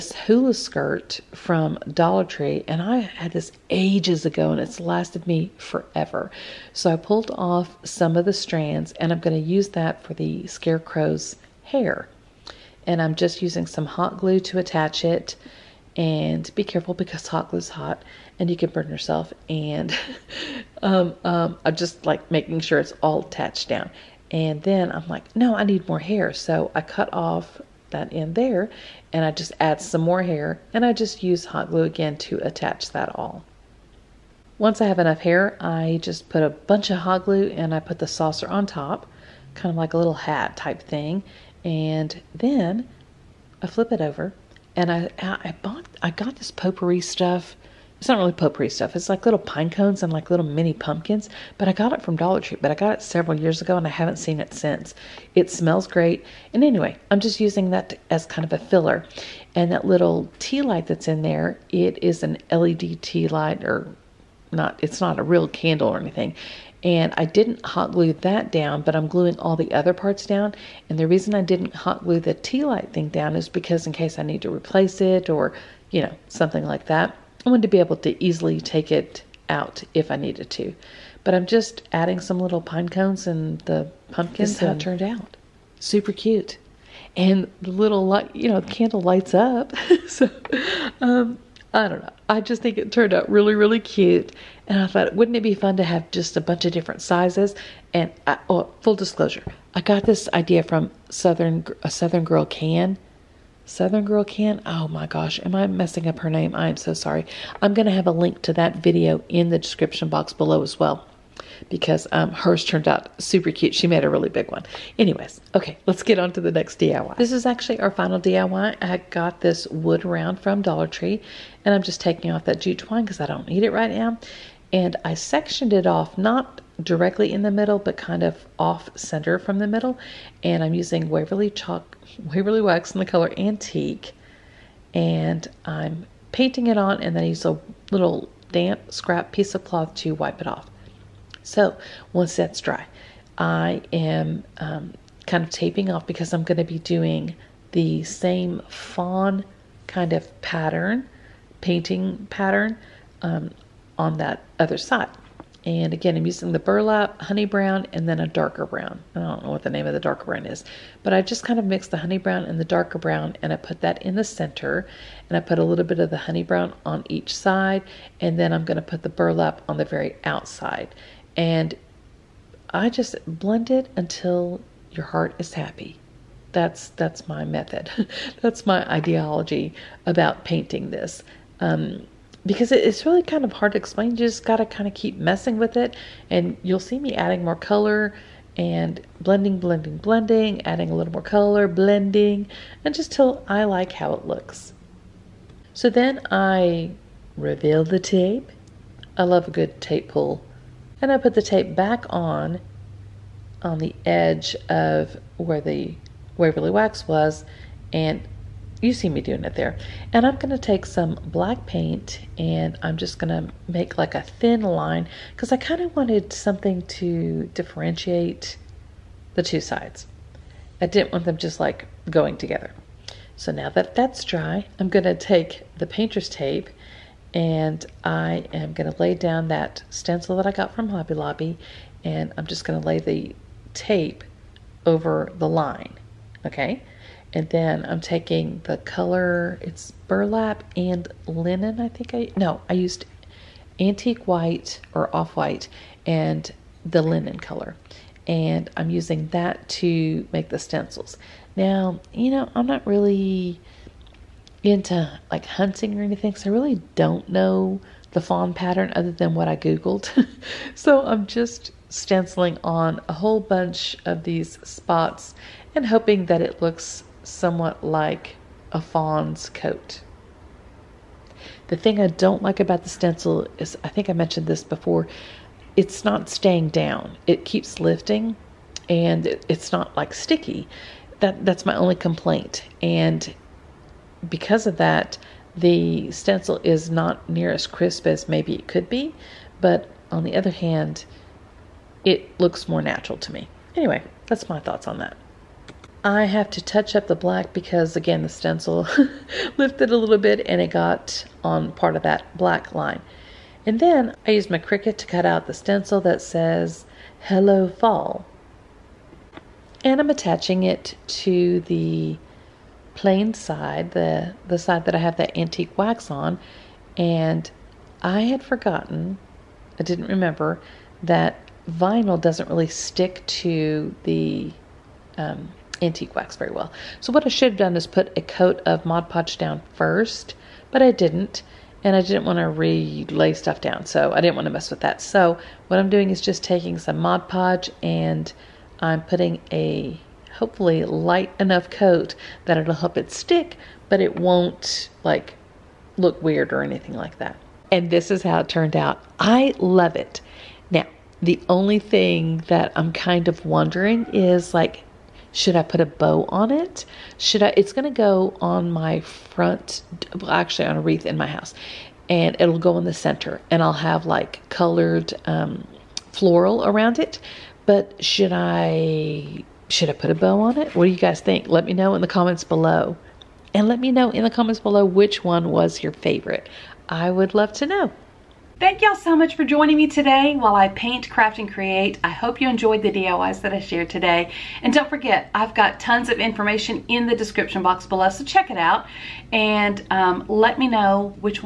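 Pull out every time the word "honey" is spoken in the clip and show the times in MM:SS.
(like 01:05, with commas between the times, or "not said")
02:37, 02:41, 02:46.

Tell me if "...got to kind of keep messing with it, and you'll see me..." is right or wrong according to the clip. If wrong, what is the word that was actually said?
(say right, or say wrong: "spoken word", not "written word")
right.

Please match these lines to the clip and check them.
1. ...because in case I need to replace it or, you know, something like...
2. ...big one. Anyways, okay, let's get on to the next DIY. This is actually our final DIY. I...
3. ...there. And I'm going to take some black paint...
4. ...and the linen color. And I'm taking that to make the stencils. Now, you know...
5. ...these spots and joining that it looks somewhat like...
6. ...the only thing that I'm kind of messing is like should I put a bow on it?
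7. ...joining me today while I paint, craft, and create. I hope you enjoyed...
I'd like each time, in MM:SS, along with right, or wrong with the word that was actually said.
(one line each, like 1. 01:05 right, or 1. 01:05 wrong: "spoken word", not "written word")
1. 01:13 right
2. 01:54 right
3. 03:29 right
4. 04:06 wrong: "using", not "taking"
5. 04:24 wrong: "hoping", not "joining"
6. 05:51 wrong: "wondering", not "messing"
7. 06:19 right.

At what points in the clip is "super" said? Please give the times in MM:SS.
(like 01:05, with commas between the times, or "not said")
01:25, 01:53.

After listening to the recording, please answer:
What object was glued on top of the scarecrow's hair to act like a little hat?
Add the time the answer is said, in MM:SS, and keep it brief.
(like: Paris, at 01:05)
Saucer, at 00:38.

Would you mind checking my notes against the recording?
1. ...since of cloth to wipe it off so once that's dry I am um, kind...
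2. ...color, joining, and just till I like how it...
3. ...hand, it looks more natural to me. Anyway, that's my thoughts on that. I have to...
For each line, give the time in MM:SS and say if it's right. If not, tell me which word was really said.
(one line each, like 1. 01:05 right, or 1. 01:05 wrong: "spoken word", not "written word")
1. 02:19 wrong: "piece", not "since"
2. 03:11 wrong: "blending", not "joining"
3. 04:50 right.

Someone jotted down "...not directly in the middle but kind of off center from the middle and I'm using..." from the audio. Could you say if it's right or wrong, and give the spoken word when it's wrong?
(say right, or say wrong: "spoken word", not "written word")
right.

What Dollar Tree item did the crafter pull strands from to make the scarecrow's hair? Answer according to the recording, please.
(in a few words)
Hula skirt.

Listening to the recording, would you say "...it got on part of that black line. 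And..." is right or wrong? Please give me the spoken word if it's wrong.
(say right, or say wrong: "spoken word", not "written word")
right.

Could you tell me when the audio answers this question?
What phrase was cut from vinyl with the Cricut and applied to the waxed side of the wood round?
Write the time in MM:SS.
05:07.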